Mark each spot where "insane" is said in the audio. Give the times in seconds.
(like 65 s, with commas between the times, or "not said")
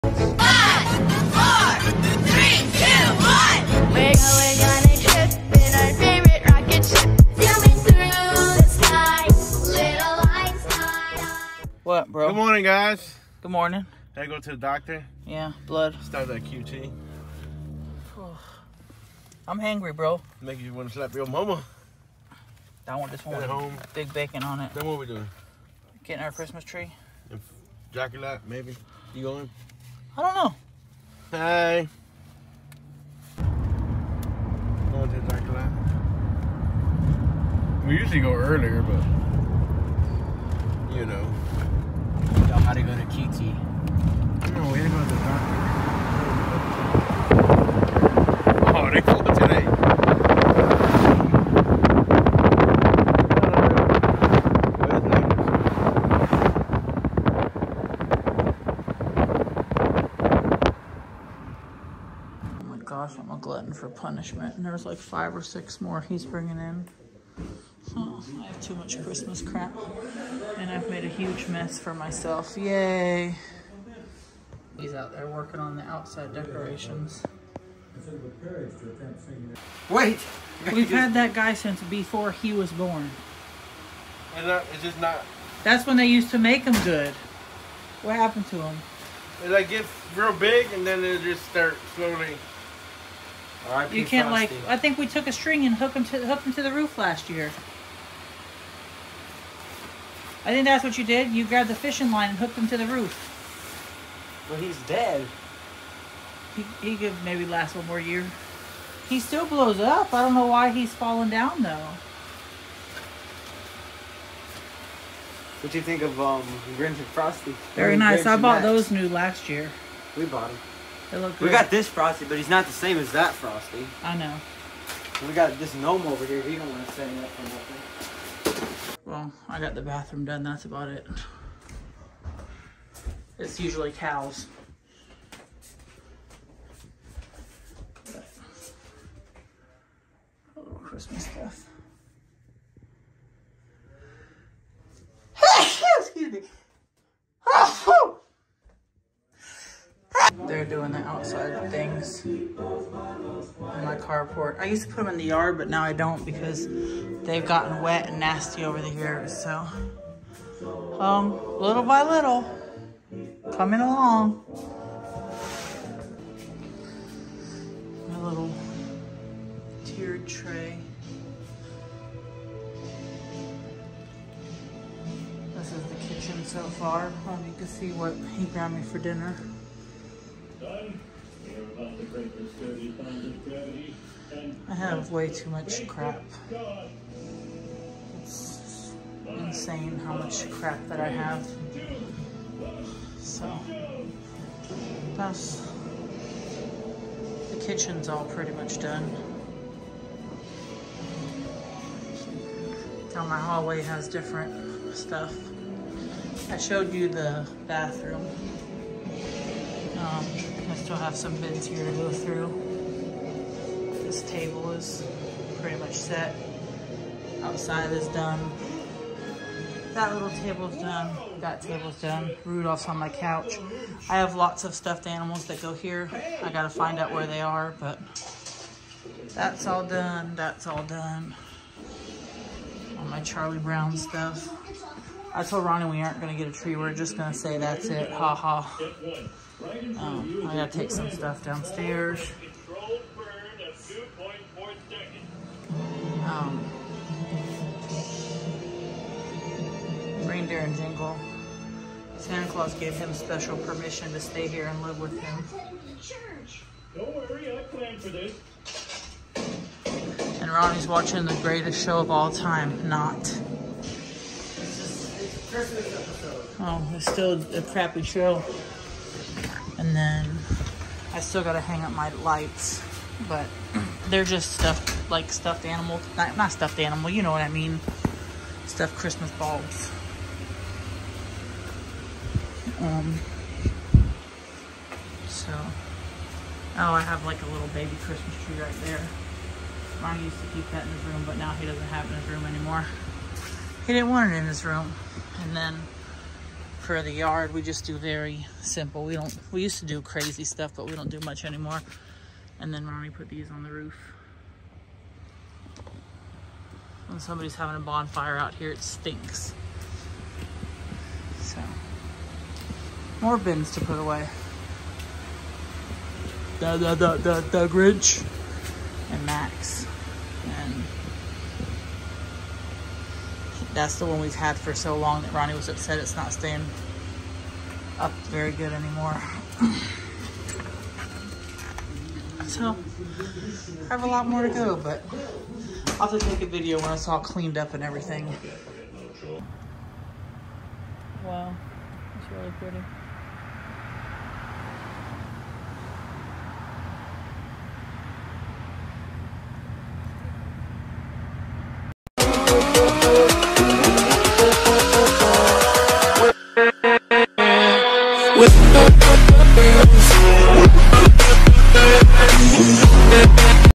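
189 s.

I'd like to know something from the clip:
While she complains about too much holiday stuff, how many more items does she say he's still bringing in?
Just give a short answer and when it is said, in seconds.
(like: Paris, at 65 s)
5 or 6, at 64 s.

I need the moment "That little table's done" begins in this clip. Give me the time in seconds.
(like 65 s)
219 s.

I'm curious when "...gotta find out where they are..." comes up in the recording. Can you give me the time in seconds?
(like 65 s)
226 s.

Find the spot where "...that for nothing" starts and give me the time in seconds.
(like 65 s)
127 s.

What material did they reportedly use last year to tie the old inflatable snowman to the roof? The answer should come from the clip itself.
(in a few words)
fishing line.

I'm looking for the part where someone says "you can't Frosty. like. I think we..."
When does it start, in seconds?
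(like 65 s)
93 s.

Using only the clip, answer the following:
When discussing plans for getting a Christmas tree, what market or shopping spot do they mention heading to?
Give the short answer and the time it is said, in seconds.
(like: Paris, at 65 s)
Jockey Lot, at 35 s.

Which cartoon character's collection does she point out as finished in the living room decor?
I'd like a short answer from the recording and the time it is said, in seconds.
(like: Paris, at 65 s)
Charlie Brown, at 233 s.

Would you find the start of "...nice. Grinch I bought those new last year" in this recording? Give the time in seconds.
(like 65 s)
117 s.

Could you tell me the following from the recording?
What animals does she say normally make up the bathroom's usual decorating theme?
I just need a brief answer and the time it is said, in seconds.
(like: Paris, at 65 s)
cows, at 133 s.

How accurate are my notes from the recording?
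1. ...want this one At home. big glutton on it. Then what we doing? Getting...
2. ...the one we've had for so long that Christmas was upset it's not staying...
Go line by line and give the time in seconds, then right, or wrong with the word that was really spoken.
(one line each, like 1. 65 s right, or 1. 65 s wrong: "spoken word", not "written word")
1. 22 s wrong: "bacon", not "glutton"
2. 323 s wrong: "Ronnie", not "Christmas".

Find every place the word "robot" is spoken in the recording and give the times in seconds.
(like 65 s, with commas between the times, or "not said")
not said.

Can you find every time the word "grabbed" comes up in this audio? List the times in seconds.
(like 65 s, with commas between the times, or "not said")
101 s, 178 s.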